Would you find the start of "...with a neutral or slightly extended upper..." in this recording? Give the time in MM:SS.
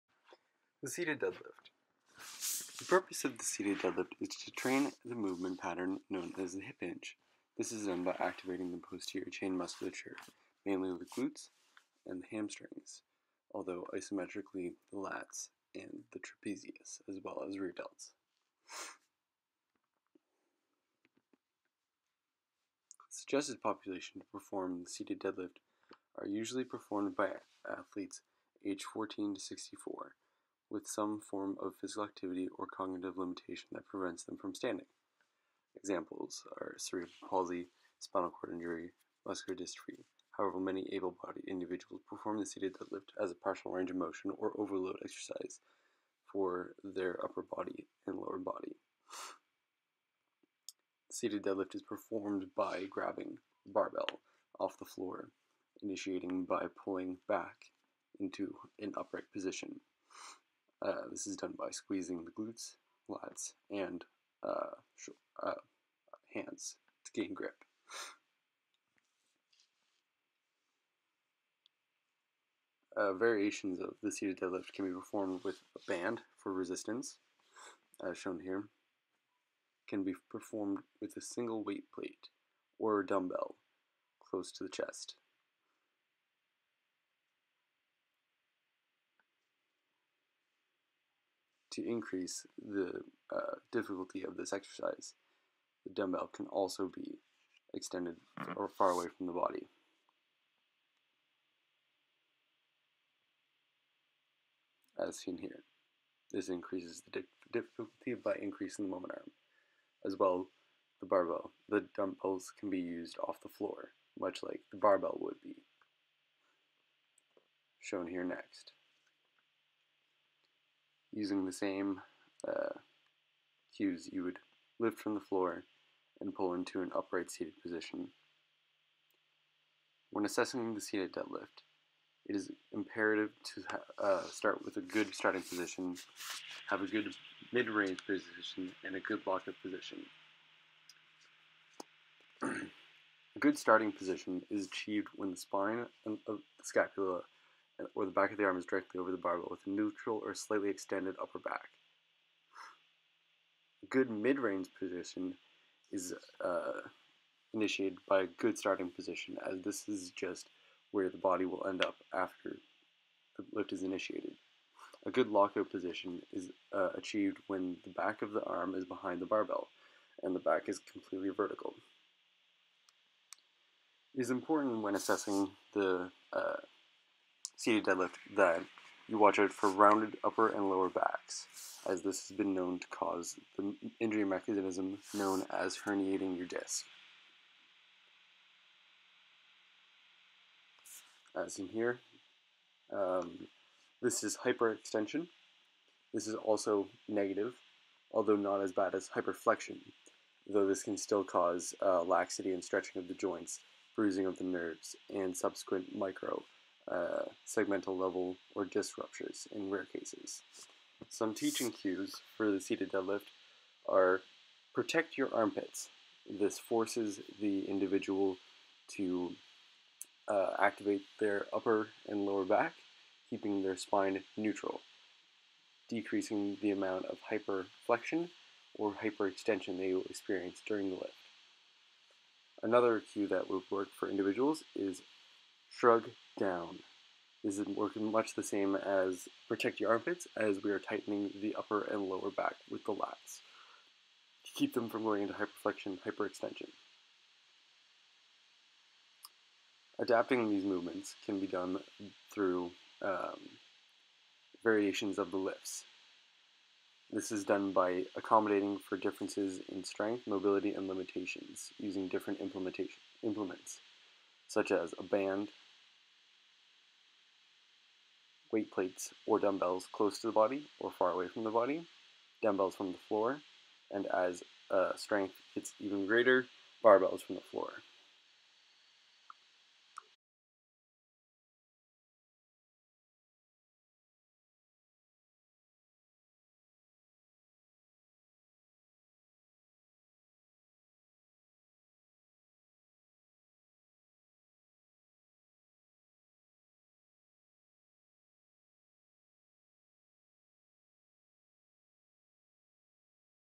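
02:29.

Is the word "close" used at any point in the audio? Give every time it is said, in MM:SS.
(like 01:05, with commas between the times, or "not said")
01:24, 04:29.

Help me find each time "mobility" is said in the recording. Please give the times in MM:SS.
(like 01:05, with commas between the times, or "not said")
04:20.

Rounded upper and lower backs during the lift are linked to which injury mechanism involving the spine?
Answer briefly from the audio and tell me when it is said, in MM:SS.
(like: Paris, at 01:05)
herniating your disc, at 03:05.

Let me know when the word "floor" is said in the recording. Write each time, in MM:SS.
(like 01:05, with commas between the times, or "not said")
00:54, 01:53, 02:05, 04:33, 04:37.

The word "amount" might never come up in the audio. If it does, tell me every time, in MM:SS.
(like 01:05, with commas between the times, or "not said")
03:46.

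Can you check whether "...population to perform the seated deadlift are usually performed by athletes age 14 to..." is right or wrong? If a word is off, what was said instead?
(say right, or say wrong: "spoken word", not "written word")
right.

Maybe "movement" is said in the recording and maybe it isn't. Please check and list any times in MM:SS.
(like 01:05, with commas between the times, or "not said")
00:05, 04:10.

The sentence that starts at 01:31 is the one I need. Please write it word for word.
to increase the uh, difficulty of this exercise.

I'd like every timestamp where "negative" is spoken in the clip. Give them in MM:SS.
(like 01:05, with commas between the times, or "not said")
03:17.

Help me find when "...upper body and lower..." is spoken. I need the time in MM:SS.
00:47.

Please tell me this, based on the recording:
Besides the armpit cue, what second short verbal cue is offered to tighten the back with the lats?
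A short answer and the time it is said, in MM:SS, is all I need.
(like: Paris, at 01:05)
shrug down, at 03:55.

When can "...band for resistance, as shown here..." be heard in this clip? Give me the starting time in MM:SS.
01:15.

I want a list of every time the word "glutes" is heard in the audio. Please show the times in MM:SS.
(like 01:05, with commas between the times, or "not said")
00:11, 01:02.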